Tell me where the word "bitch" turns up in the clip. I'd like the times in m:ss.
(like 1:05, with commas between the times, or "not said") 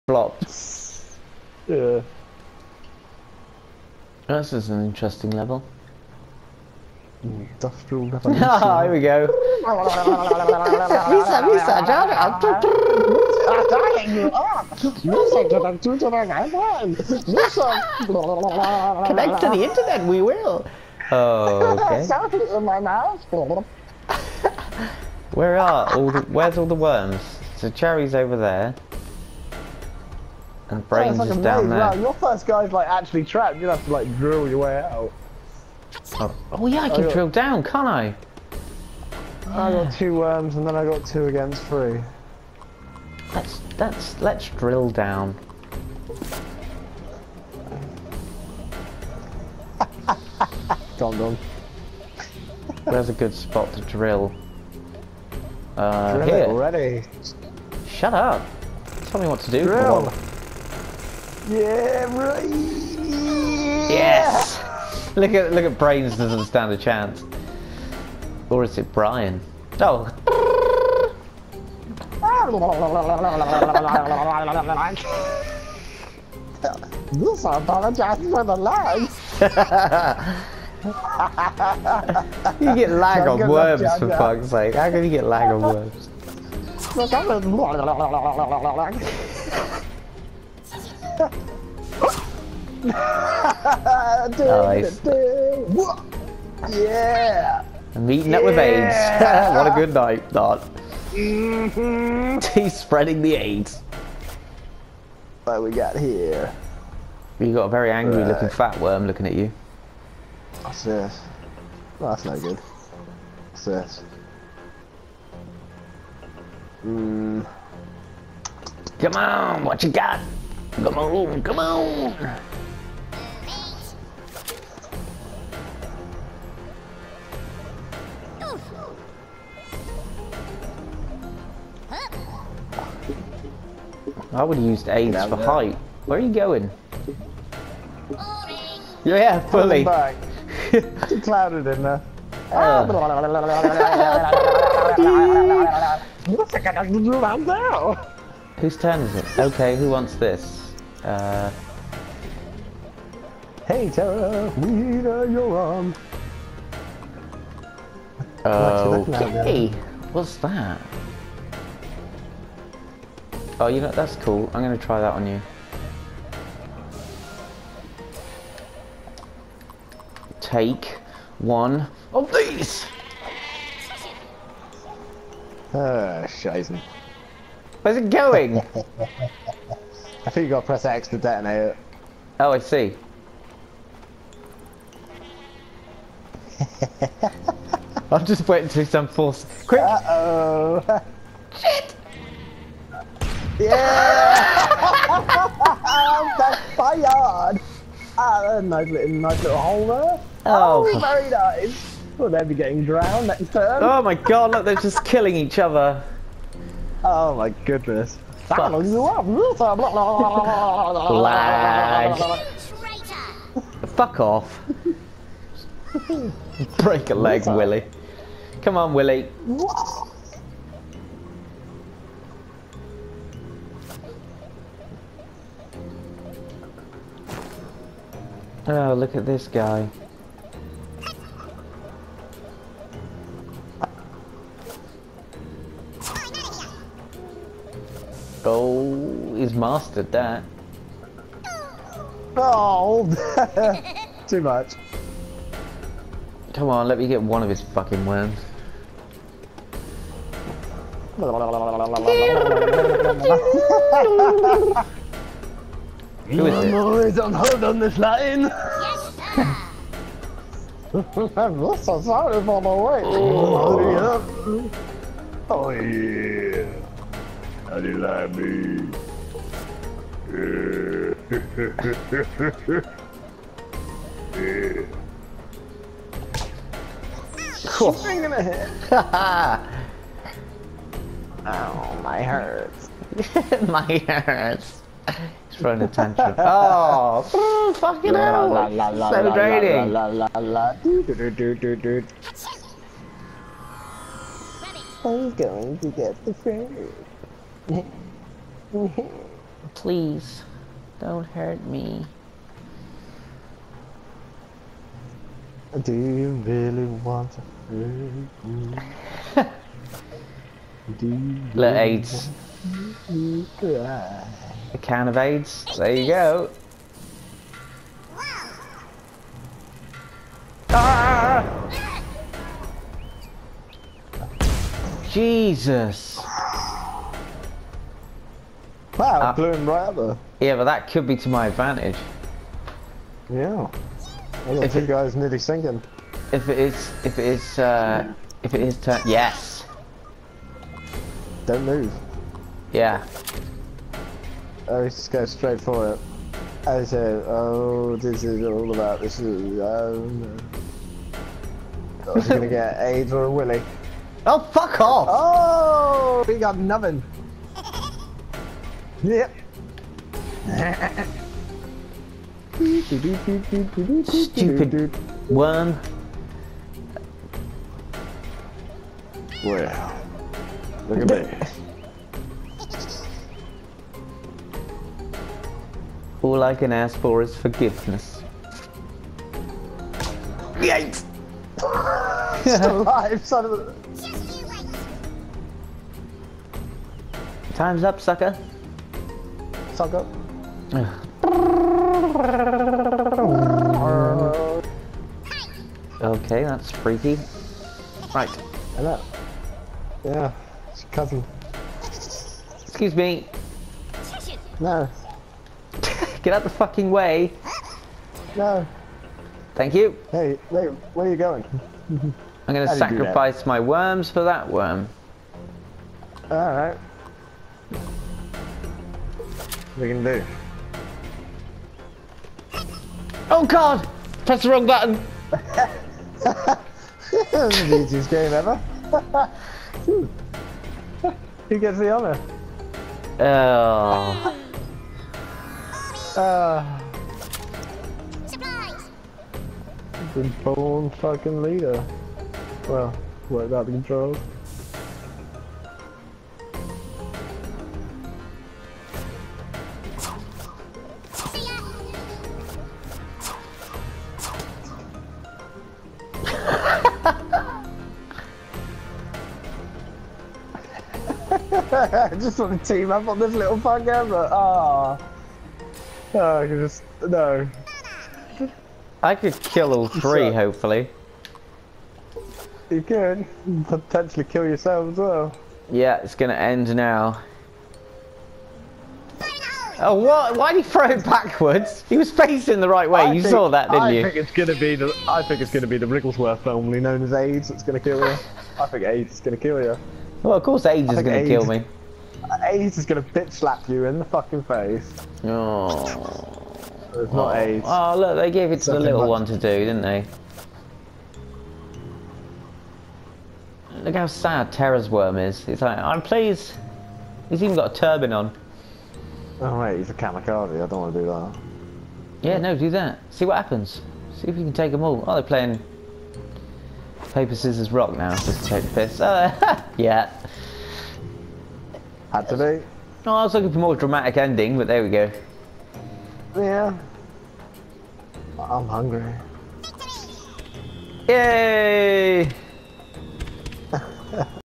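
8:13.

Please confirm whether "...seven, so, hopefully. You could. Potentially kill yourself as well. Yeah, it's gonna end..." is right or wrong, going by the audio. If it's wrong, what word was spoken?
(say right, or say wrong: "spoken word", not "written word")
wrong: "three", not "seven".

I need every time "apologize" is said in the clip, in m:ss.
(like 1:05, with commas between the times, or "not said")
1:17.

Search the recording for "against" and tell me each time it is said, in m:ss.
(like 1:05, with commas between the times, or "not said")
0:41.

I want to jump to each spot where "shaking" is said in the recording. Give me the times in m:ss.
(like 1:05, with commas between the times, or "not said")
not said.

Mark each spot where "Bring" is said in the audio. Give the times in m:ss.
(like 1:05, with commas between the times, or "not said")
4:38.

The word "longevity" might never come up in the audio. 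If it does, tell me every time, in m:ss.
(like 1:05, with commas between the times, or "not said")
not said.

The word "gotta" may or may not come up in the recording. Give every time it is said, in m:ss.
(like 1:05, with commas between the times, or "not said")
3:00.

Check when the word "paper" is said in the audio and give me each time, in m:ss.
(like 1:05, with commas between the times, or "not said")
8:37.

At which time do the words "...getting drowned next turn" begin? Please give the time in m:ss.
3:22.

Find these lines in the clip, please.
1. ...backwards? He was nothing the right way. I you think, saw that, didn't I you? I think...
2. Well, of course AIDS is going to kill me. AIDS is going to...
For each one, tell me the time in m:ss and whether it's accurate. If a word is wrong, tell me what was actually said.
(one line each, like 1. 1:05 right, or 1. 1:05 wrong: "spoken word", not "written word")
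1. 8:01 wrong: "facing", not "nothing"
2. 8:10 right.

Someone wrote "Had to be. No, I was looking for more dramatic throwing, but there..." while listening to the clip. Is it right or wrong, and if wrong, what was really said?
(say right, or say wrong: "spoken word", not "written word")
wrong: "ending", not "throwing".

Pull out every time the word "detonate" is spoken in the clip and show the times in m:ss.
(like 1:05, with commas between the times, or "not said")
3:01.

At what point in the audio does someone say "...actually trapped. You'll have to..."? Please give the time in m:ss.
0:32.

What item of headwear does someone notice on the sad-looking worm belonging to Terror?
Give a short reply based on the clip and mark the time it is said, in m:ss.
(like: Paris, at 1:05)
A turban, at 8:27.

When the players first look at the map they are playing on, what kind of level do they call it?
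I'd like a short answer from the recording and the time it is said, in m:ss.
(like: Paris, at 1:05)
Industrial, at 0:07.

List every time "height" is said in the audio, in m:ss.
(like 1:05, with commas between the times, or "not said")
2:15.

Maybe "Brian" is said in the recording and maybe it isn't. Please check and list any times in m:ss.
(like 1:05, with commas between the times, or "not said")
1:08.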